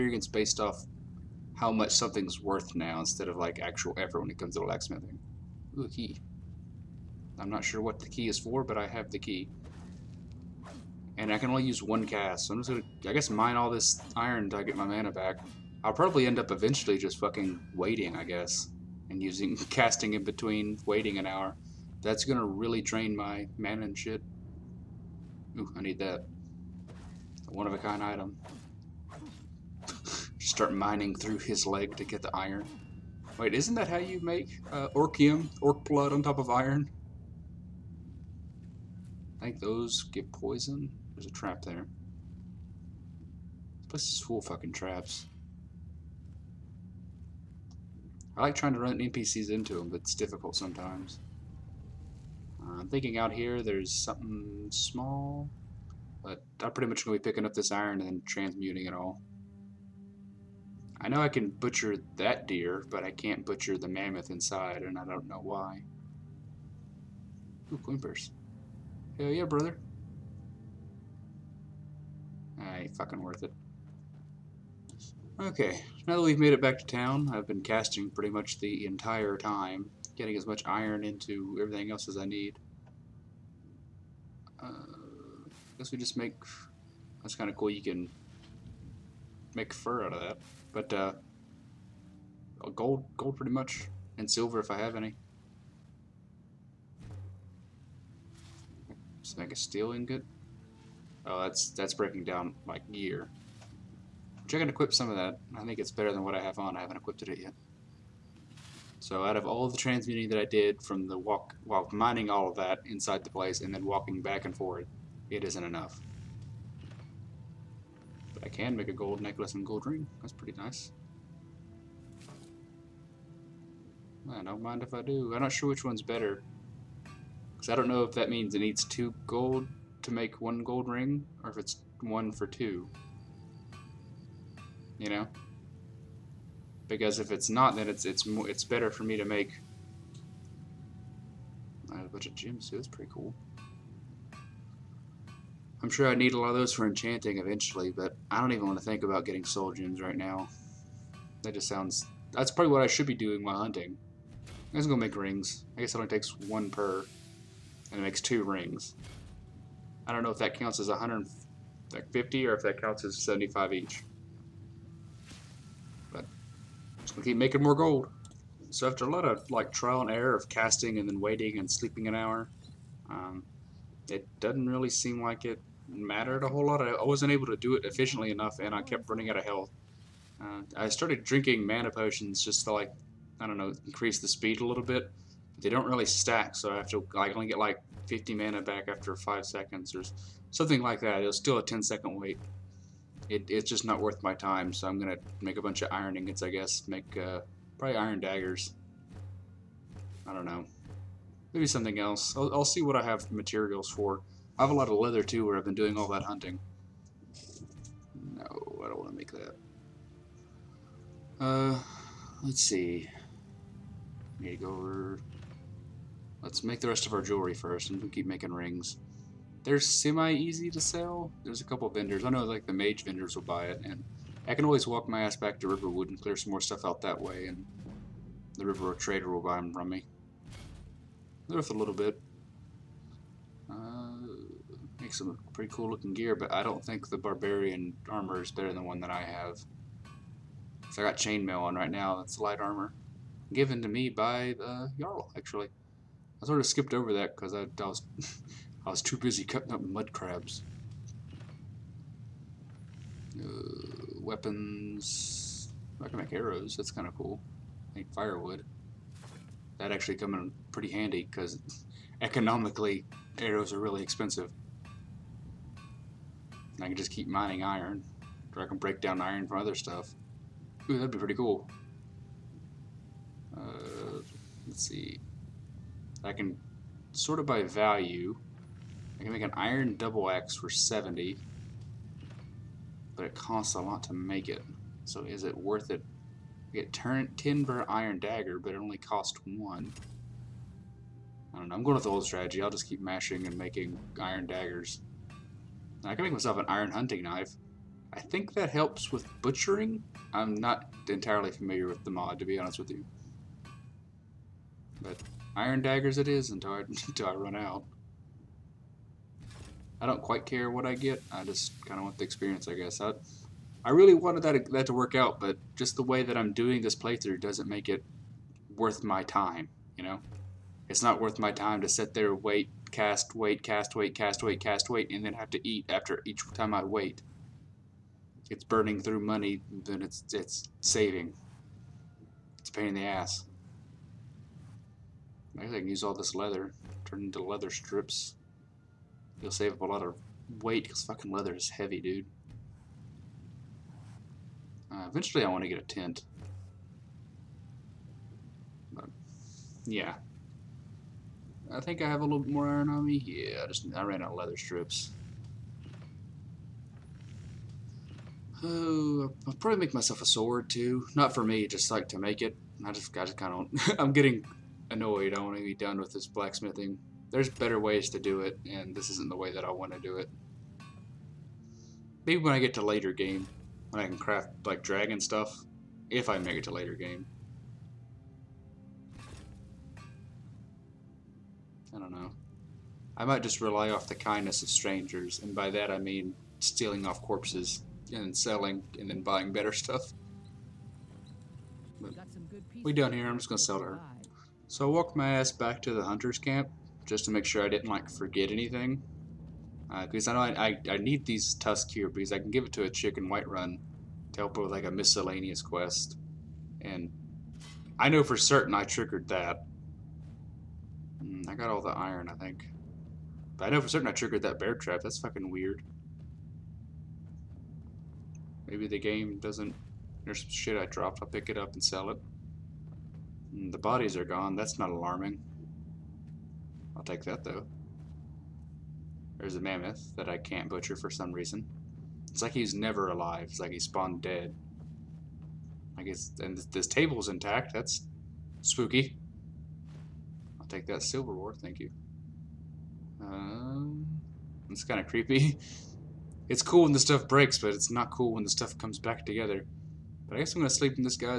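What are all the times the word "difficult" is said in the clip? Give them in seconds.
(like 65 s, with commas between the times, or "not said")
50 s.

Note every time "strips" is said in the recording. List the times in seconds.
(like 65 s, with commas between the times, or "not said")
337 s, 354 s.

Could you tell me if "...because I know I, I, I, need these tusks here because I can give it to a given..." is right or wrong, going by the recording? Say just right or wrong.
wrong.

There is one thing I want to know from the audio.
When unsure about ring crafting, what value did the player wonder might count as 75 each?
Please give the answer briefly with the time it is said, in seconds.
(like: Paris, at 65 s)
150, at 160 s.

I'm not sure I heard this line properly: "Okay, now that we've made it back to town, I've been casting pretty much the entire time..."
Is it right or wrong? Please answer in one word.
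right.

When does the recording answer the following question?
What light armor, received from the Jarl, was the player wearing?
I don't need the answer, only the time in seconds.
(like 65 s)
241 s.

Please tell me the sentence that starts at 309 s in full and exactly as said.
I don't quite care what I get.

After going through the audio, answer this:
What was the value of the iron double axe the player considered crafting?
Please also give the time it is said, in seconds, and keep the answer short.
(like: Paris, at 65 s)
70, at 280 s.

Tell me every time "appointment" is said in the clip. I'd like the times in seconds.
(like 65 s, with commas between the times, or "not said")
not said.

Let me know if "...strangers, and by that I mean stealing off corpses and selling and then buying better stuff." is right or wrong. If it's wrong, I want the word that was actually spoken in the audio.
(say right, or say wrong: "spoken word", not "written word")
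right.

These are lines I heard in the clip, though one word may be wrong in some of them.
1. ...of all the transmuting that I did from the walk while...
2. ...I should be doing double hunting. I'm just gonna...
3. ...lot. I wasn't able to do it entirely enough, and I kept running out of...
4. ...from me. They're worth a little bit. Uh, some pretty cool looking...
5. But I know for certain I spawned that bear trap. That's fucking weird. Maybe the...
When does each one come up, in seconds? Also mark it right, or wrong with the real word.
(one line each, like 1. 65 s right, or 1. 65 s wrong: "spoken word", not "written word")
1. 109 s right
2. 152 s wrong: "while", not "double"
3. 176 s wrong: "efficiently", not "entirely"
4. 229 s right
5. 413 s wrong: "triggered", not "spawned".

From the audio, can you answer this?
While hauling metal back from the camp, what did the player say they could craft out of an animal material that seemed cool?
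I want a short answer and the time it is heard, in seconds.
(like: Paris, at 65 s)
fur, at 89 s.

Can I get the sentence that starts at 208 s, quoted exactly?
No, I don't want to make that.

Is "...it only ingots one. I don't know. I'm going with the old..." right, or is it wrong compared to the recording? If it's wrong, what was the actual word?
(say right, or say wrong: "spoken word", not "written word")
wrong: "costs", not "ingots".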